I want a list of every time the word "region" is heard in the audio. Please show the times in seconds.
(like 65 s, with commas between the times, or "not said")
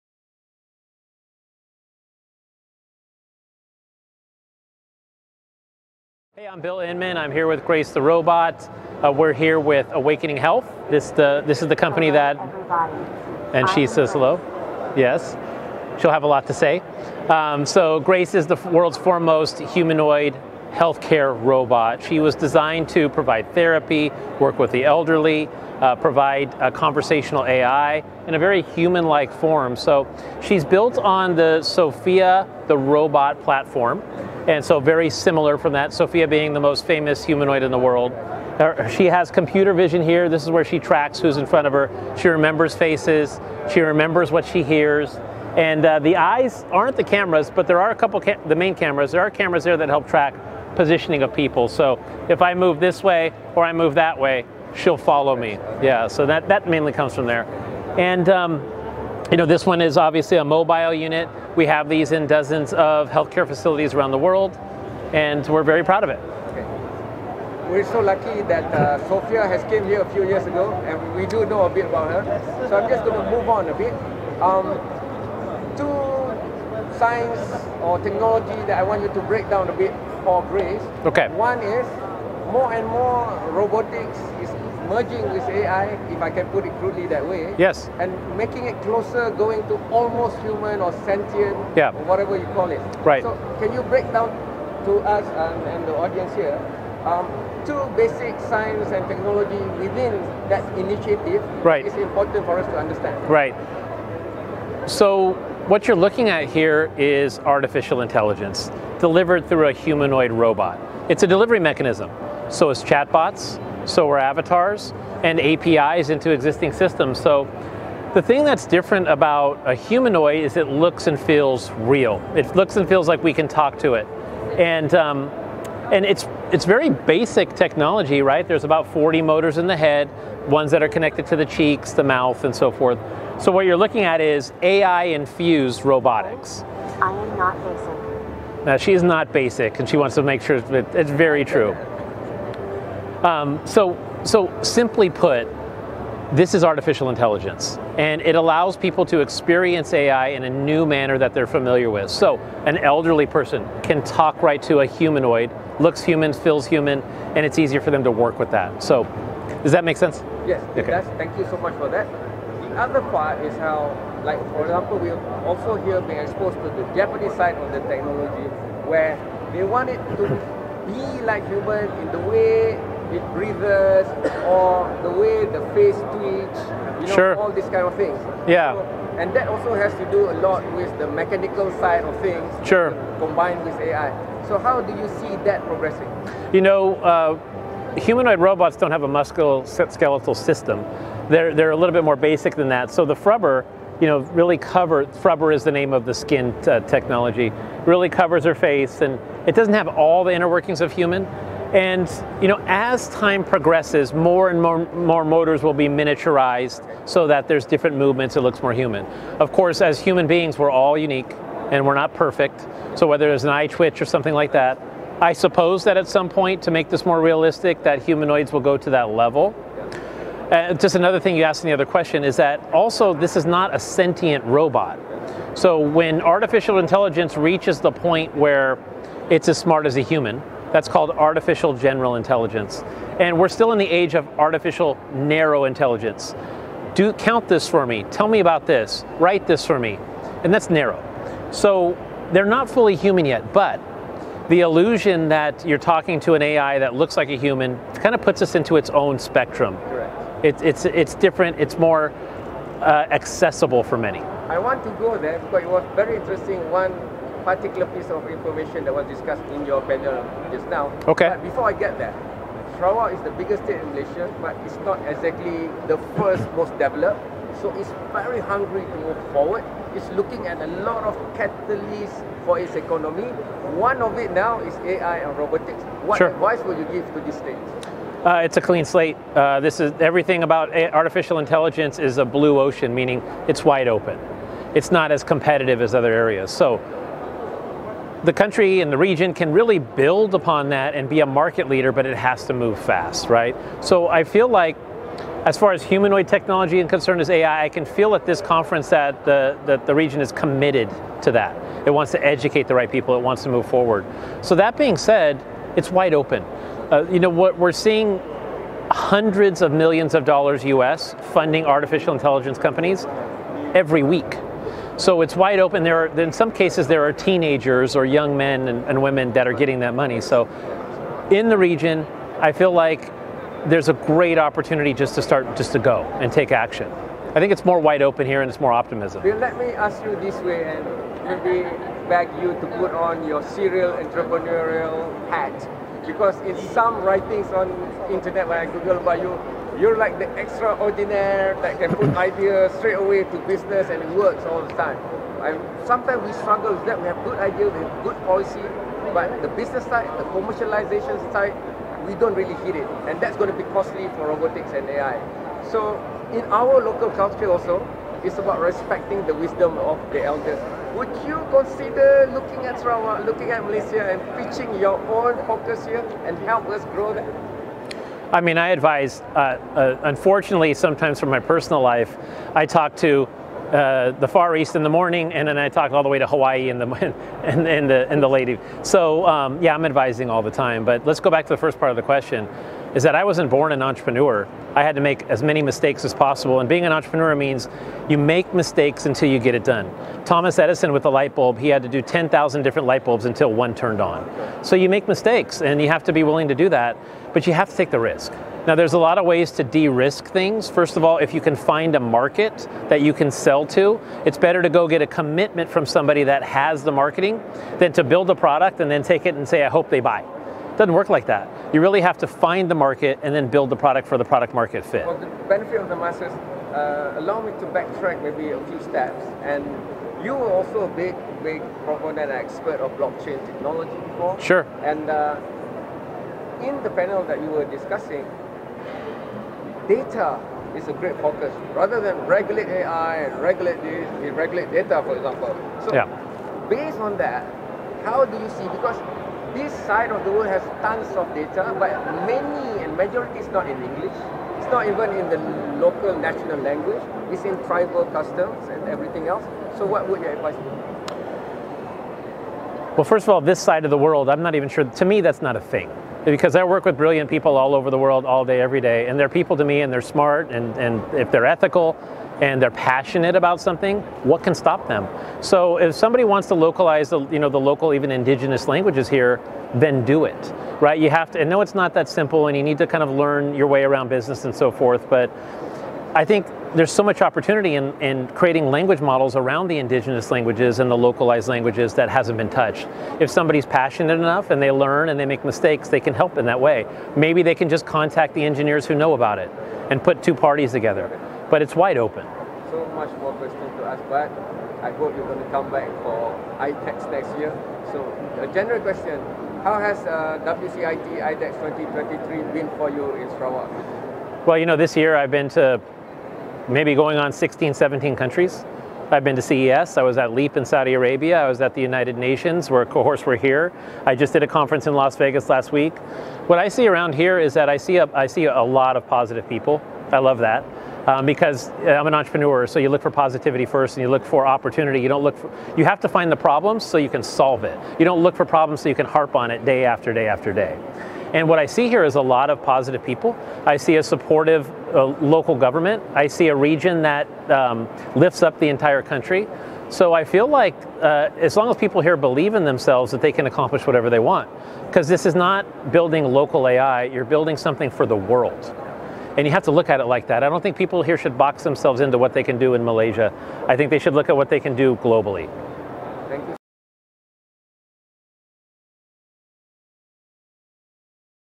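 288 s, 299 s, 321 s, 536 s.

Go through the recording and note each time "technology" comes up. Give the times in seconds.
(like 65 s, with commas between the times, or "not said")
77 s, 99 s, 127 s, 167 s, 196 s, 296 s, 423 s.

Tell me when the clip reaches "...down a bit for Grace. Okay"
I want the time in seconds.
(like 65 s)
79 s.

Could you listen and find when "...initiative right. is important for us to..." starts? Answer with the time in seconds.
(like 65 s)
100 s.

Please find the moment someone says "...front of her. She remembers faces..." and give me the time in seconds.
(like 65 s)
41 s.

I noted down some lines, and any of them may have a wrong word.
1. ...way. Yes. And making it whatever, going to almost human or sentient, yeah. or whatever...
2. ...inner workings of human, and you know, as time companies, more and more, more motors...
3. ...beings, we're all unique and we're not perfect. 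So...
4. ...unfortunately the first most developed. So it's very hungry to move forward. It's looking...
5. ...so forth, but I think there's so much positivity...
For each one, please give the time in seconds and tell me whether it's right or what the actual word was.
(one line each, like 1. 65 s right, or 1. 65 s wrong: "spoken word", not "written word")
1. 87 s wrong: "closer", not "whatever"
2. 200 s wrong: "progresses", not "companies"
3. 210 s right
4. 265 s wrong: "exactly", not "unfortunately"
5. 474 s wrong: "opportunity", not "positivity".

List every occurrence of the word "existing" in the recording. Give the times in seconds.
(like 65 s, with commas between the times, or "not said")
116 s.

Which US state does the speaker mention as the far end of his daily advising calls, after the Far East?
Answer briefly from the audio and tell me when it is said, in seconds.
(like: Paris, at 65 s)
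Hawaii, at 376 s.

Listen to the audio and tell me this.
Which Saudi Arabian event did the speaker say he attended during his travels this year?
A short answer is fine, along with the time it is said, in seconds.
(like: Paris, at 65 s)
LEAP, at 510 s.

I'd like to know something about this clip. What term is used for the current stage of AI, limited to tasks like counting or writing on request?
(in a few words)
artificial narrow intelligence.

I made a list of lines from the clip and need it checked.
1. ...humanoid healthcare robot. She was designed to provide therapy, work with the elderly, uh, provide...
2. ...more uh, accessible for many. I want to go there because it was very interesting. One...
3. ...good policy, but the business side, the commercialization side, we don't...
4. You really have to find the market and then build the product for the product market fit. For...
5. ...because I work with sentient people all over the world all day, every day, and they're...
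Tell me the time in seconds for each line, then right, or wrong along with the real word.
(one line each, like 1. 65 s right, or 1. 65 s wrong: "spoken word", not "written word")
1. 19 s right
2. 251 s right
3. 348 s right
4. 411 s right
5. 456 s wrong: "brilliant", not "sentient".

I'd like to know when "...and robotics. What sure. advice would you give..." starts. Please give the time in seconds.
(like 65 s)
275 s.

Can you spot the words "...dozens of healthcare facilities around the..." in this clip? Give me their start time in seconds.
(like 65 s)
62 s.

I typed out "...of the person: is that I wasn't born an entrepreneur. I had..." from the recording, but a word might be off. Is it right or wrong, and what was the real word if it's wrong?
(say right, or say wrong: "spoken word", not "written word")
wrong: "question", not "person".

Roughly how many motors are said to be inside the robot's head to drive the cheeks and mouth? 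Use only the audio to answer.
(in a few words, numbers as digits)
40.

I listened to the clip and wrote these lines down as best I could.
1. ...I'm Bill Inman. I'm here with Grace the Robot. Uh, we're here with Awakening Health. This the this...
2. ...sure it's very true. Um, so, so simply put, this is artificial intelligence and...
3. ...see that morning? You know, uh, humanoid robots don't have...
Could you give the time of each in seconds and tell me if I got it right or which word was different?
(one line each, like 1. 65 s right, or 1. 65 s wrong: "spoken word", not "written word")
1. 6 s right
2. 140 s right
3. 185 s wrong: "progressing", not "morning".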